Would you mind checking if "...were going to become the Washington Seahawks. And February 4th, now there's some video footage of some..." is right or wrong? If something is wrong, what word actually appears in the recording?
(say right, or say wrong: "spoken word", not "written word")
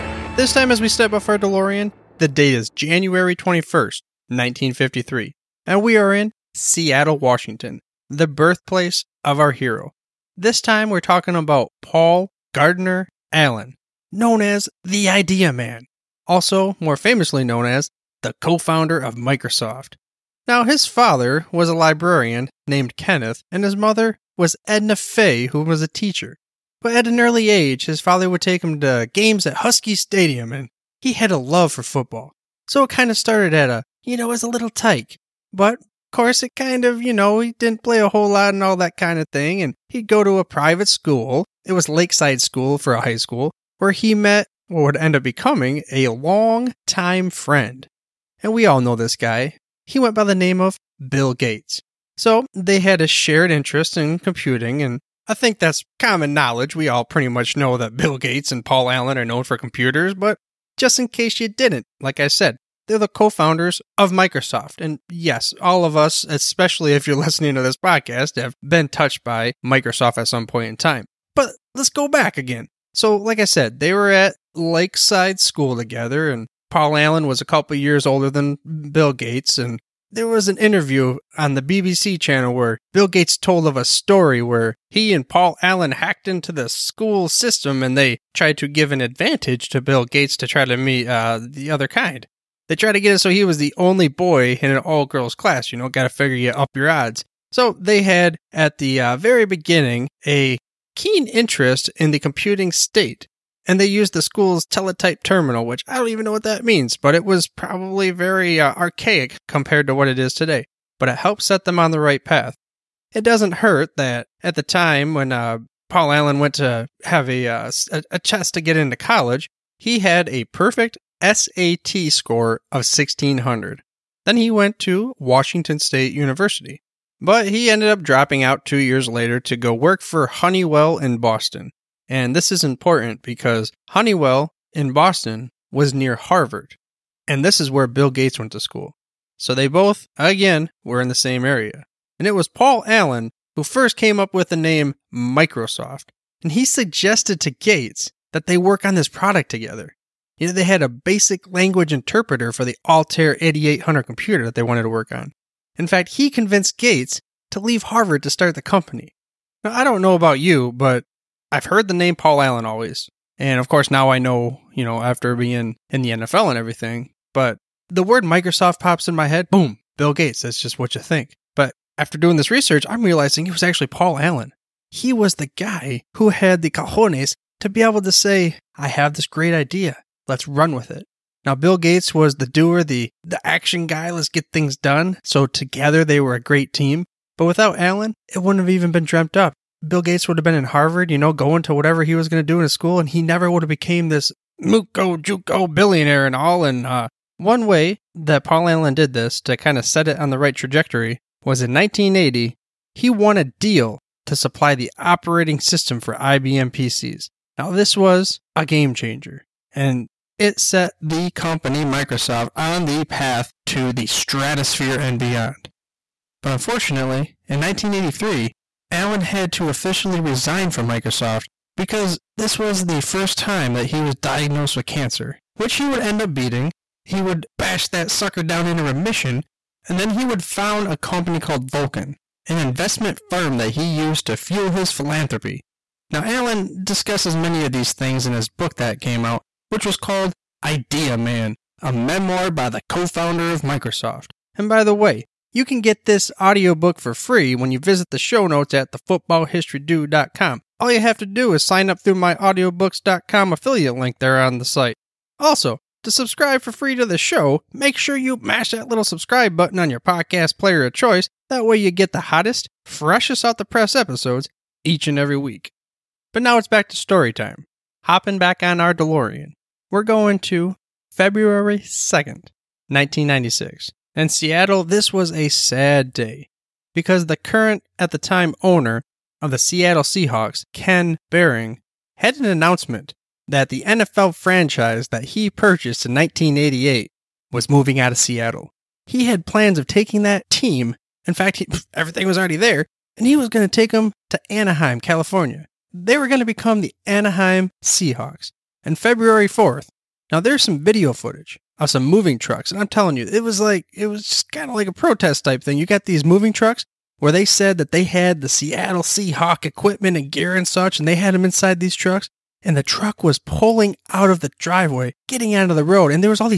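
wrong: "Anaheim", not "Washington".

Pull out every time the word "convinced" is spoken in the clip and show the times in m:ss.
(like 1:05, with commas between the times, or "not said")
2:36.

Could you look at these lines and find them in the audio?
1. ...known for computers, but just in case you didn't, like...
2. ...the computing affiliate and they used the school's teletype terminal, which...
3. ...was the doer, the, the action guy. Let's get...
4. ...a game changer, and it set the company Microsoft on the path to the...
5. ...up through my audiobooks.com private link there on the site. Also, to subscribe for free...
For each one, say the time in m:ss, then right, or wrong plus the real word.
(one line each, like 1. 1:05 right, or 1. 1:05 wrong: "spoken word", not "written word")
1. 0:59 right
2. 1:42 wrong: "state", not "affiliate"
3. 3:02 right
4. 3:28 right
5. 4:11 wrong: "affiliate", not "private".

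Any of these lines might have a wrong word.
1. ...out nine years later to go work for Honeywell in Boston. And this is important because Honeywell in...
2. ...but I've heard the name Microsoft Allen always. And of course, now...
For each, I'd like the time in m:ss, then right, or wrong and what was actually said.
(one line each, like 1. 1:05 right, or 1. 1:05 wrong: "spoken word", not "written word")
1. 2:08 wrong: "two", not "nine"
2. 2:40 wrong: "Paul", not "Microsoft".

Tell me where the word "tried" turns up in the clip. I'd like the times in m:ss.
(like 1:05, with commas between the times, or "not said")
1:28, 1:32.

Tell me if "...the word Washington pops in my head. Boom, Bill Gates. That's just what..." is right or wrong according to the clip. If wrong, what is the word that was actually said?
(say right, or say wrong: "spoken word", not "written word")
wrong: "Microsoft", not "Washington".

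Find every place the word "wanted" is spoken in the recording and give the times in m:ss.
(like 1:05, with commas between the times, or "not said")
2:34.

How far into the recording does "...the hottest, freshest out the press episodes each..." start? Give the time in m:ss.
4:22.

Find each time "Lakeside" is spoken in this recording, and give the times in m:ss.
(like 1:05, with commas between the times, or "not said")
0:41, 1:14.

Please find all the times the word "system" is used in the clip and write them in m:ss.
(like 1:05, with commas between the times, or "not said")
1:27, 3:25.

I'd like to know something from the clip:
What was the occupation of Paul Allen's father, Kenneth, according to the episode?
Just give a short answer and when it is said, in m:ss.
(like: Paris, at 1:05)
Librarian, at 0:21.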